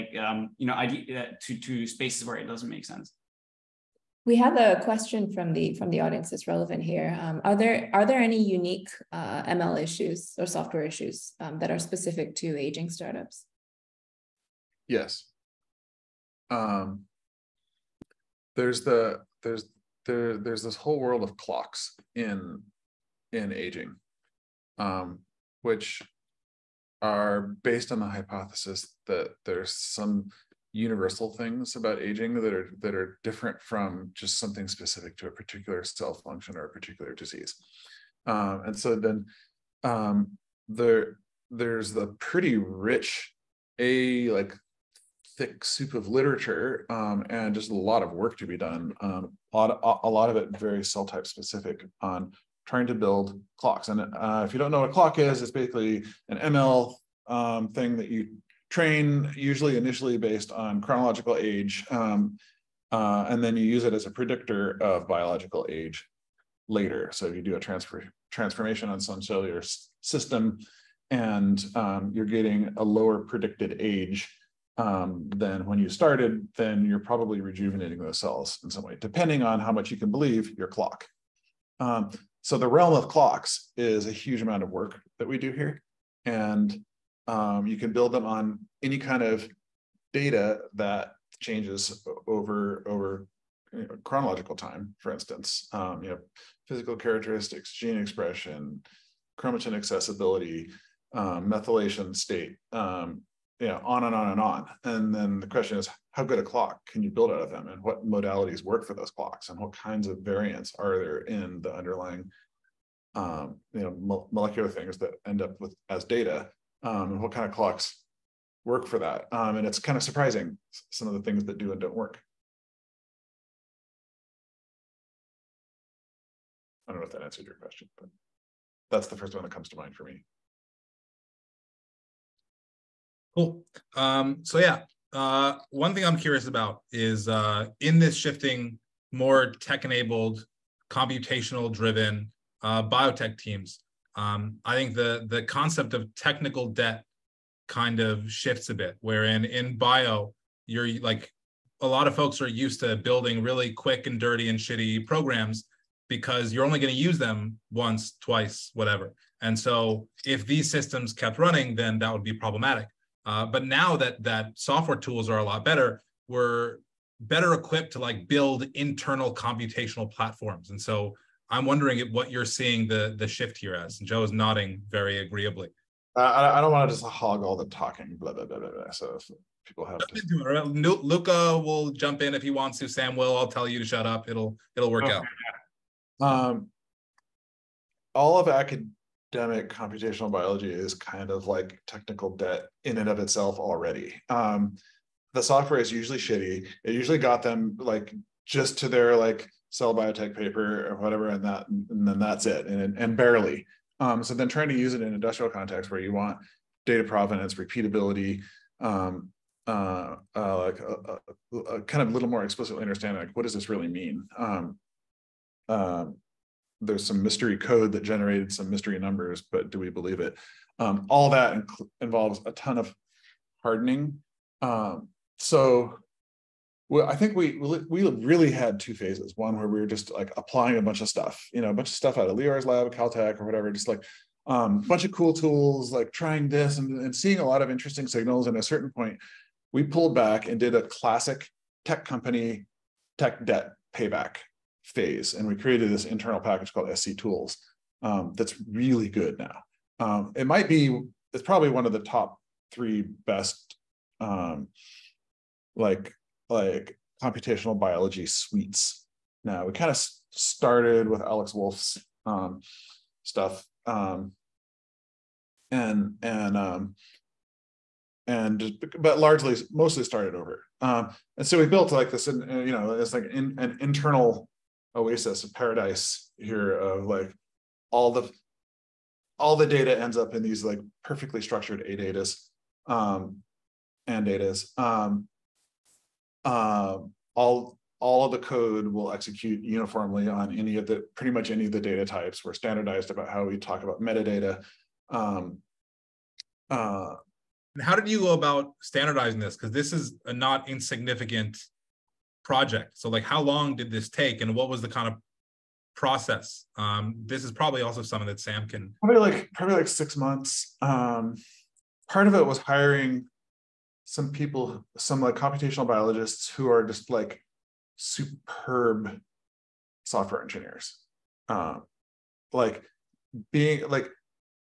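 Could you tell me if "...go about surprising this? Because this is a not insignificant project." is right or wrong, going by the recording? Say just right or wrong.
wrong.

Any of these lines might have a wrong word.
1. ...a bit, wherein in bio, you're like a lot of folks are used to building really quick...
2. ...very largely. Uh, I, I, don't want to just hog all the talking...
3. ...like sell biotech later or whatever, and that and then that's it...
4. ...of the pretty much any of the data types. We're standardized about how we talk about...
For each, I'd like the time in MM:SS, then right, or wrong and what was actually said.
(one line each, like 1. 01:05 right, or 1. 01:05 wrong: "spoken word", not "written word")
1. 02:28 right
2. 02:54 wrong: "agreeably", not "largely"
3. 03:19 wrong: "paper", not "later"
4. 04:50 right.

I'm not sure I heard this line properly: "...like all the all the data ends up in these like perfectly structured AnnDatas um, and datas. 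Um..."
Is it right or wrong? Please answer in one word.
right.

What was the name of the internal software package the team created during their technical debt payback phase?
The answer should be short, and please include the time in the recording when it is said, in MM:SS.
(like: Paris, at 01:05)
SC Tools, at 04:06.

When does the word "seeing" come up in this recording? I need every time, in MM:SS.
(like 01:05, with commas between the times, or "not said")
02:52, 03:57.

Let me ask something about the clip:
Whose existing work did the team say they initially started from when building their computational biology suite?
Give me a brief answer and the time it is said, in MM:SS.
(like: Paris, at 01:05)
Alex Wolf, at 04:21.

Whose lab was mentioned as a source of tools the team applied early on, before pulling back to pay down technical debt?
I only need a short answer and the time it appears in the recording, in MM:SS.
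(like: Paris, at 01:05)
Lior's lab, at 03:52.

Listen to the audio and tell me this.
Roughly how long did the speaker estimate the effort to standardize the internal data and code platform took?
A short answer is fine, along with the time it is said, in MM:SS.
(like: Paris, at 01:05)
6 months, at 05:09.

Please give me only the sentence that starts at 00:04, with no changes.
We have a question from the from the audience that's relevant here.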